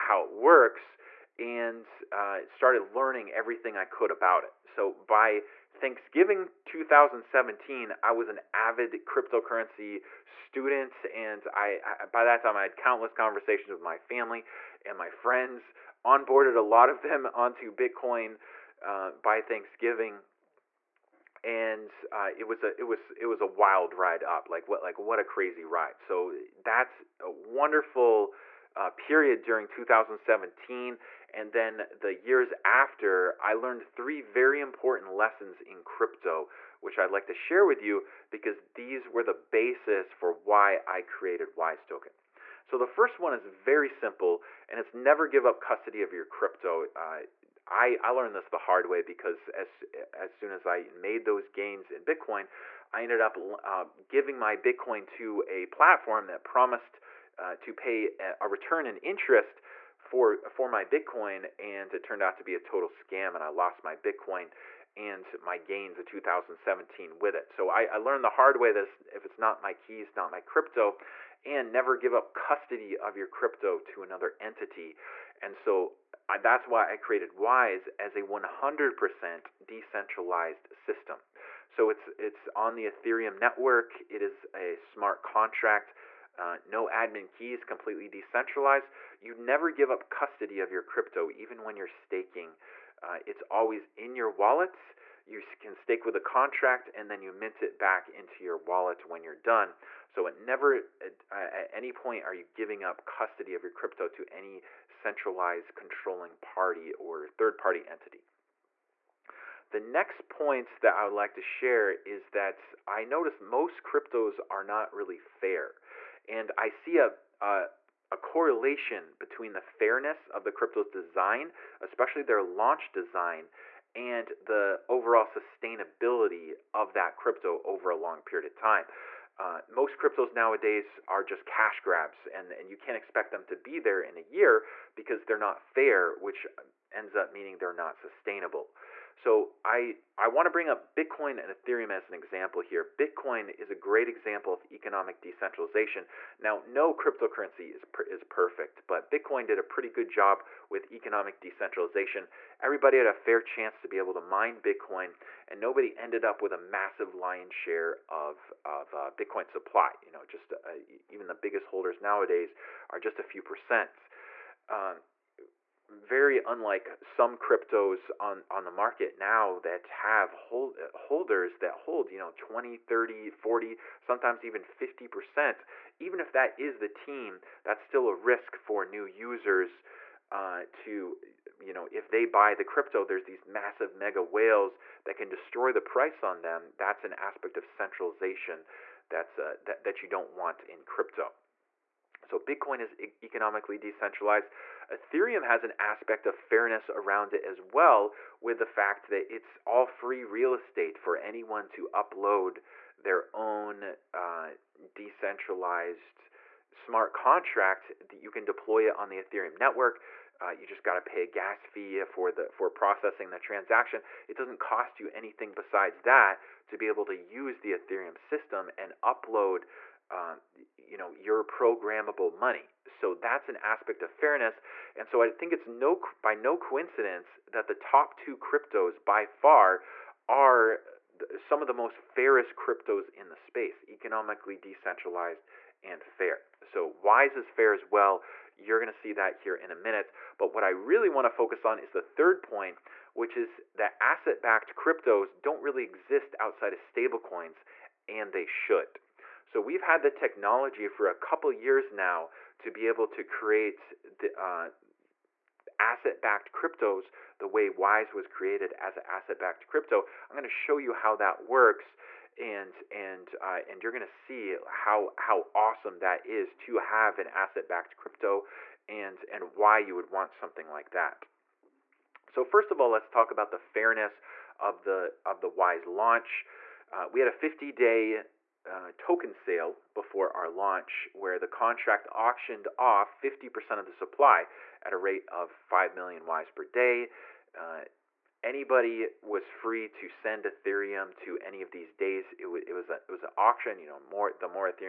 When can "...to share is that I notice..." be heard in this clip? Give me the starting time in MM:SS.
01:51.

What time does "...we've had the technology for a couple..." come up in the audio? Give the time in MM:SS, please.
04:09.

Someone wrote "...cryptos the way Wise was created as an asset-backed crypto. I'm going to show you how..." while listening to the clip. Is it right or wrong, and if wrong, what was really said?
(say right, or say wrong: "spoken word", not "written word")
right.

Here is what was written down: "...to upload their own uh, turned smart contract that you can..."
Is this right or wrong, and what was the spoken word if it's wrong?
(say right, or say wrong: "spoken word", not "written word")
wrong: "decentralized", not "turned".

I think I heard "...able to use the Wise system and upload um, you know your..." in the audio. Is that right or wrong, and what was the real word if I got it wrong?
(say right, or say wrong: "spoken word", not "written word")
wrong: "Ethereum", not "Wise".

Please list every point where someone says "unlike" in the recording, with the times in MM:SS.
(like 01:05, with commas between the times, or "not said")
02:46.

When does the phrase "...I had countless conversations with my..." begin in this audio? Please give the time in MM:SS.
00:12.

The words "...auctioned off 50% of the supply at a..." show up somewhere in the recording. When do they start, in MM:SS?
04:42.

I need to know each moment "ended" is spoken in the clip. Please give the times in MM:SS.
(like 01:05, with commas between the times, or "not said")
00:53, 02:35.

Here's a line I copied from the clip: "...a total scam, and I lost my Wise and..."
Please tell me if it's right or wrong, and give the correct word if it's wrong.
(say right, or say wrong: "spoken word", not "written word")
wrong: "Bitcoin", not "Wise".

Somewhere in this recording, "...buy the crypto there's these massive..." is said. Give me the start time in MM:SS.
03:02.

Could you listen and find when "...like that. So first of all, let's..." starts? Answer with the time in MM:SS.
04:30.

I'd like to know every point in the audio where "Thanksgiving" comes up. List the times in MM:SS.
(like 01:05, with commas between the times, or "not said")
00:05, 00:19.